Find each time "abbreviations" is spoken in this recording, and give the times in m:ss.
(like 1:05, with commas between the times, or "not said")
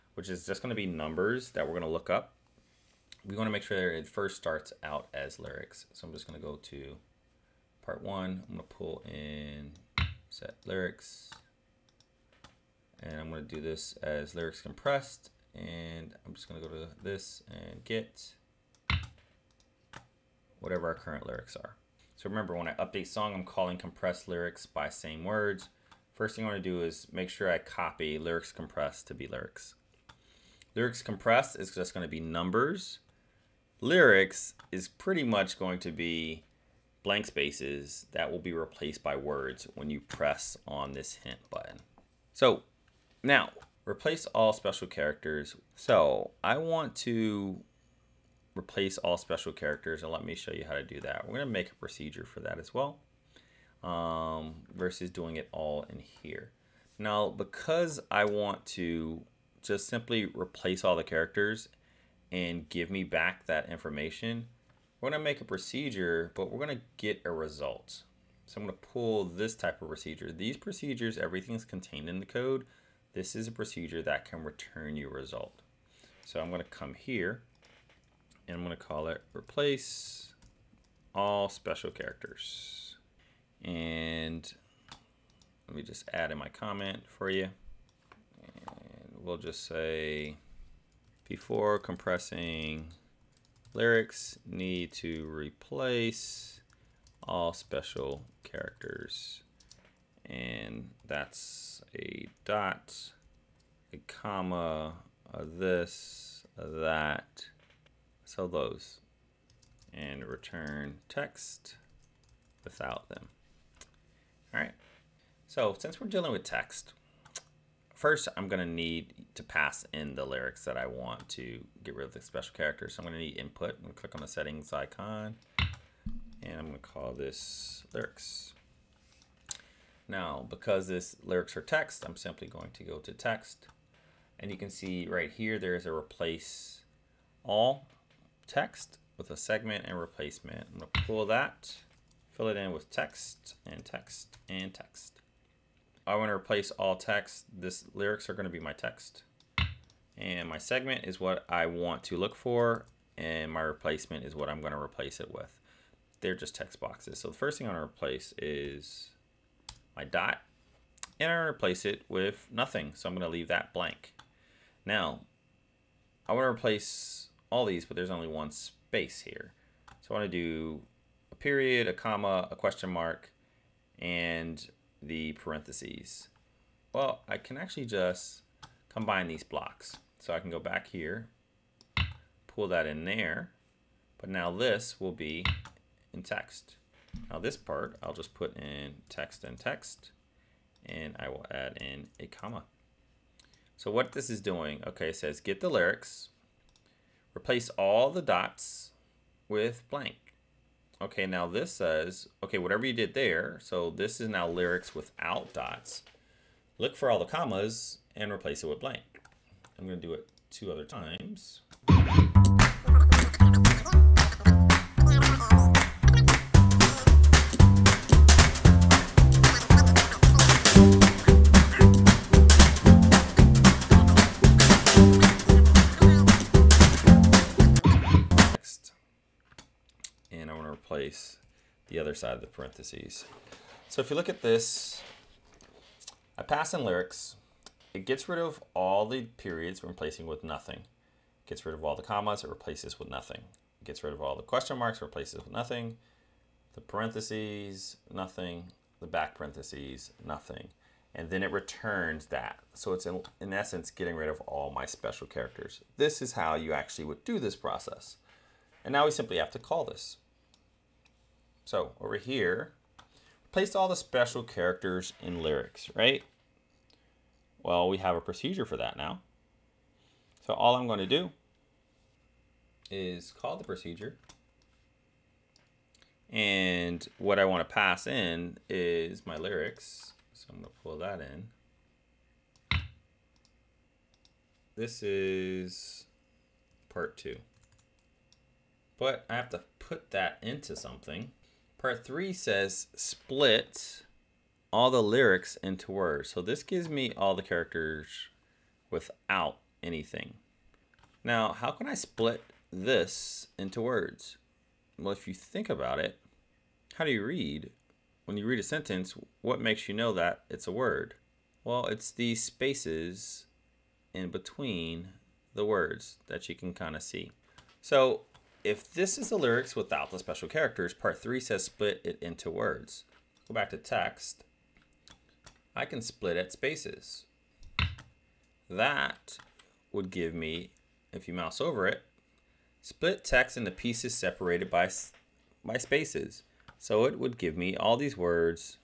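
not said.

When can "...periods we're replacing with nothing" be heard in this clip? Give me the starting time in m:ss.
3:59.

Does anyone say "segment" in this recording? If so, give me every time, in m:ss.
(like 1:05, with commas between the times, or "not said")
2:19, 2:30.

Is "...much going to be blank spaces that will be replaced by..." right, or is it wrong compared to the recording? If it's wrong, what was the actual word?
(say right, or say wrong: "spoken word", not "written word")
right.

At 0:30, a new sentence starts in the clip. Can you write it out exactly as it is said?
Lyrics compressed is just going to be numbers.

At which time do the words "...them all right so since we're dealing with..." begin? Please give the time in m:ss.
1:53.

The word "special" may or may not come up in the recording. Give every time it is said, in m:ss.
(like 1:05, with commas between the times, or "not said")
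0:44, 0:49, 1:21, 1:37, 2:02, 4:14, 4:23, 5:20.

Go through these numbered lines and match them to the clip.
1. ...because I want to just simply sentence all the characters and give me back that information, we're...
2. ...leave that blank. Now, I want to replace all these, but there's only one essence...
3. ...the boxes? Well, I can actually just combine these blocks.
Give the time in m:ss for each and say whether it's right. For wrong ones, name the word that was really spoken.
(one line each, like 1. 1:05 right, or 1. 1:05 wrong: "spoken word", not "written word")
1. 0:57 wrong: "replace", not "sentence"
2. 2:43 wrong: "space", not "essence"
3. 2:55 wrong: "parentheses", not "boxes".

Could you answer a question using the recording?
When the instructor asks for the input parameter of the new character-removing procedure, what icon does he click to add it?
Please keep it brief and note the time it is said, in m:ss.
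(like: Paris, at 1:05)
settings icon, at 2:04.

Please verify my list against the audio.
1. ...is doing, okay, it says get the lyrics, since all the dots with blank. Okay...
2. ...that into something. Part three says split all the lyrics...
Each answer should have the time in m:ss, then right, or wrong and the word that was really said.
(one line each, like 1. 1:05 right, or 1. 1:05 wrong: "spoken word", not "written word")
1. 3:14 wrong: "replace", not "since"
2. 4:50 right.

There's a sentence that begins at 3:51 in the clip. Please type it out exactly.
space the other side of the parentheses.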